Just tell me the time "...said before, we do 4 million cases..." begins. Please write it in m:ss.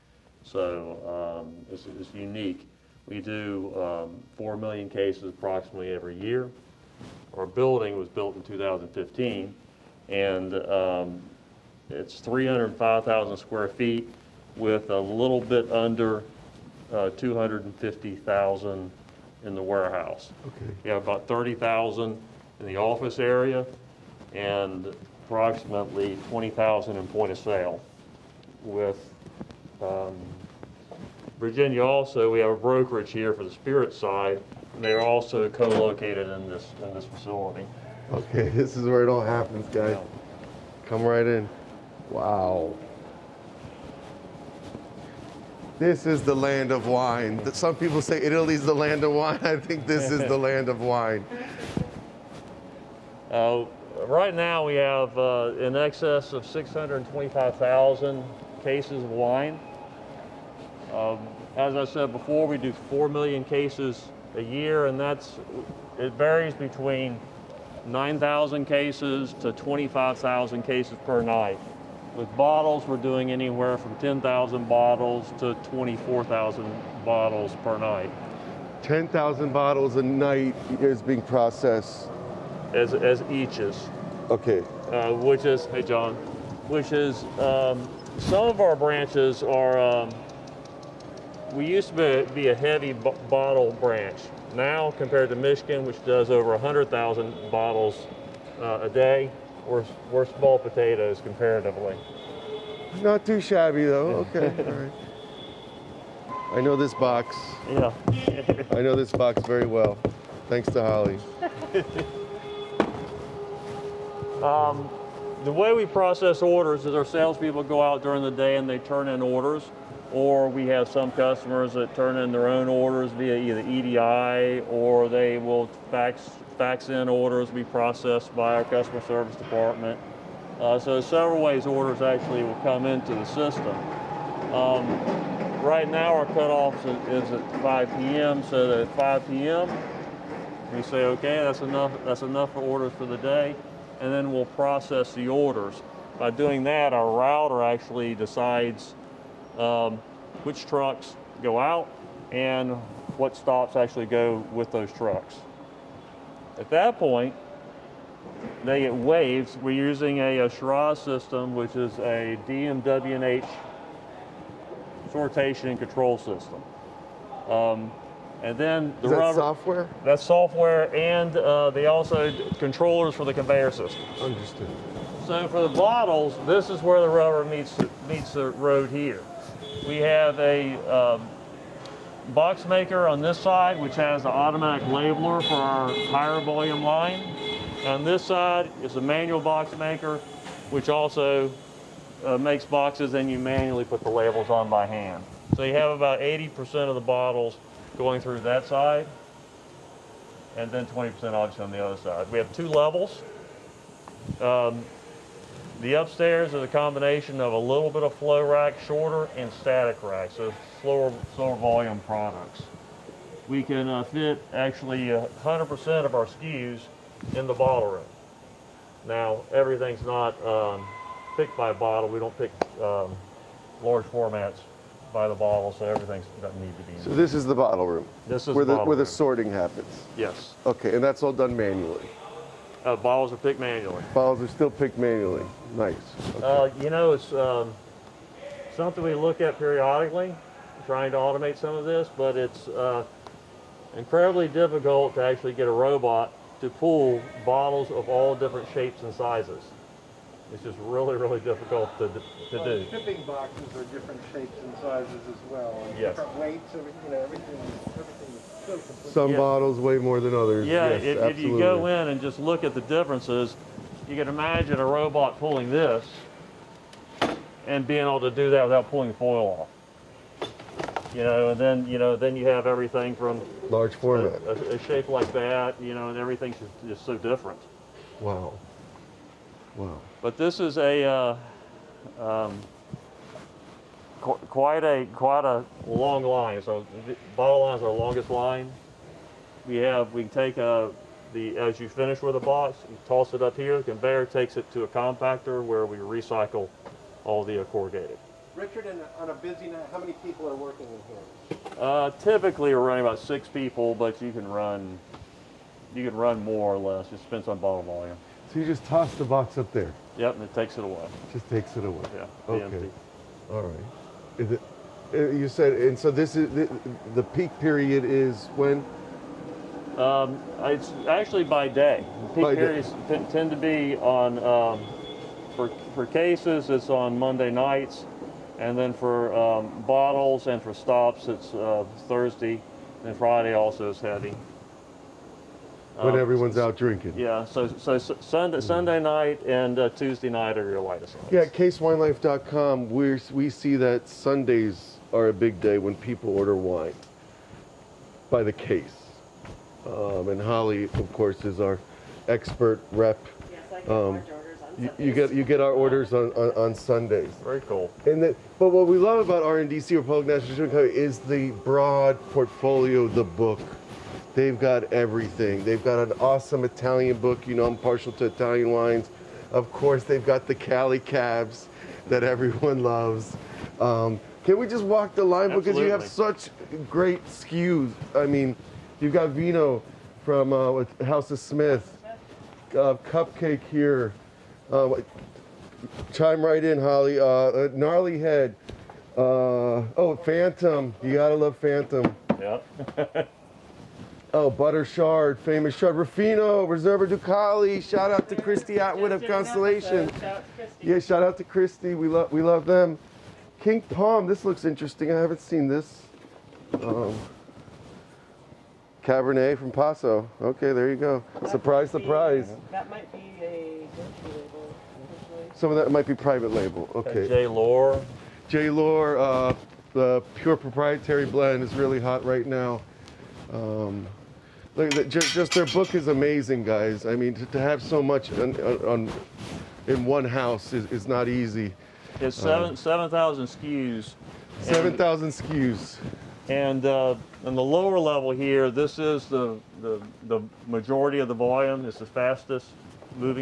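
1:01.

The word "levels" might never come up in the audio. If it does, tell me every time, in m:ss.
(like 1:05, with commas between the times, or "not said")
3:22, 7:17.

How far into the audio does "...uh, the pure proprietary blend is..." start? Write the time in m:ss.
6:59.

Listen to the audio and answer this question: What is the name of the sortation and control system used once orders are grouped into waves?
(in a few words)
Shiraz.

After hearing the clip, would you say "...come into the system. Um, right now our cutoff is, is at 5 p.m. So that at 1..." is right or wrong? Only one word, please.
wrong.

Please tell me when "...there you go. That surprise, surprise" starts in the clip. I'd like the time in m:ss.
6:50.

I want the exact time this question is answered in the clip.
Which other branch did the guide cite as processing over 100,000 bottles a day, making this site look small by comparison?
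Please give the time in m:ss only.
1:35.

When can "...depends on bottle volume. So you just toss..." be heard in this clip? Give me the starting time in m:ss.
5:07.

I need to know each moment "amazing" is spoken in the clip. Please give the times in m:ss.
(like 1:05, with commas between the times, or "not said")
7:06.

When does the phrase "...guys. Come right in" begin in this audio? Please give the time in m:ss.
0:39.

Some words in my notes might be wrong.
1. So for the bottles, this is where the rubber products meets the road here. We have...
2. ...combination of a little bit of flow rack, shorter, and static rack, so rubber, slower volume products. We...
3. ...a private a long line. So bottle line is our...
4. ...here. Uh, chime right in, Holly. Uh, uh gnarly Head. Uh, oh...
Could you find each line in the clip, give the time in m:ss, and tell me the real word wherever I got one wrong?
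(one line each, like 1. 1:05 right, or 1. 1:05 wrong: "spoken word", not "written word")
1. 2:55 wrong: "meets", not "products"
2. 3:26 wrong: "slower", not "rubber"
3. 4:44 wrong: "quite", not "private"
4. 6:23 right.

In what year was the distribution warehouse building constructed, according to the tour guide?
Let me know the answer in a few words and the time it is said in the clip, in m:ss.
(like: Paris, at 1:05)
2015, at 0:08.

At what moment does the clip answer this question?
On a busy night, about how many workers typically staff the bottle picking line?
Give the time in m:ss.
5:03.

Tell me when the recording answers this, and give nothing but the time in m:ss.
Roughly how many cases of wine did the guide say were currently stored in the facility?
0:56.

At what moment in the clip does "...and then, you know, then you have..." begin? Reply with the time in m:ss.
4:31.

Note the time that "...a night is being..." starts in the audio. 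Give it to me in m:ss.
1:19.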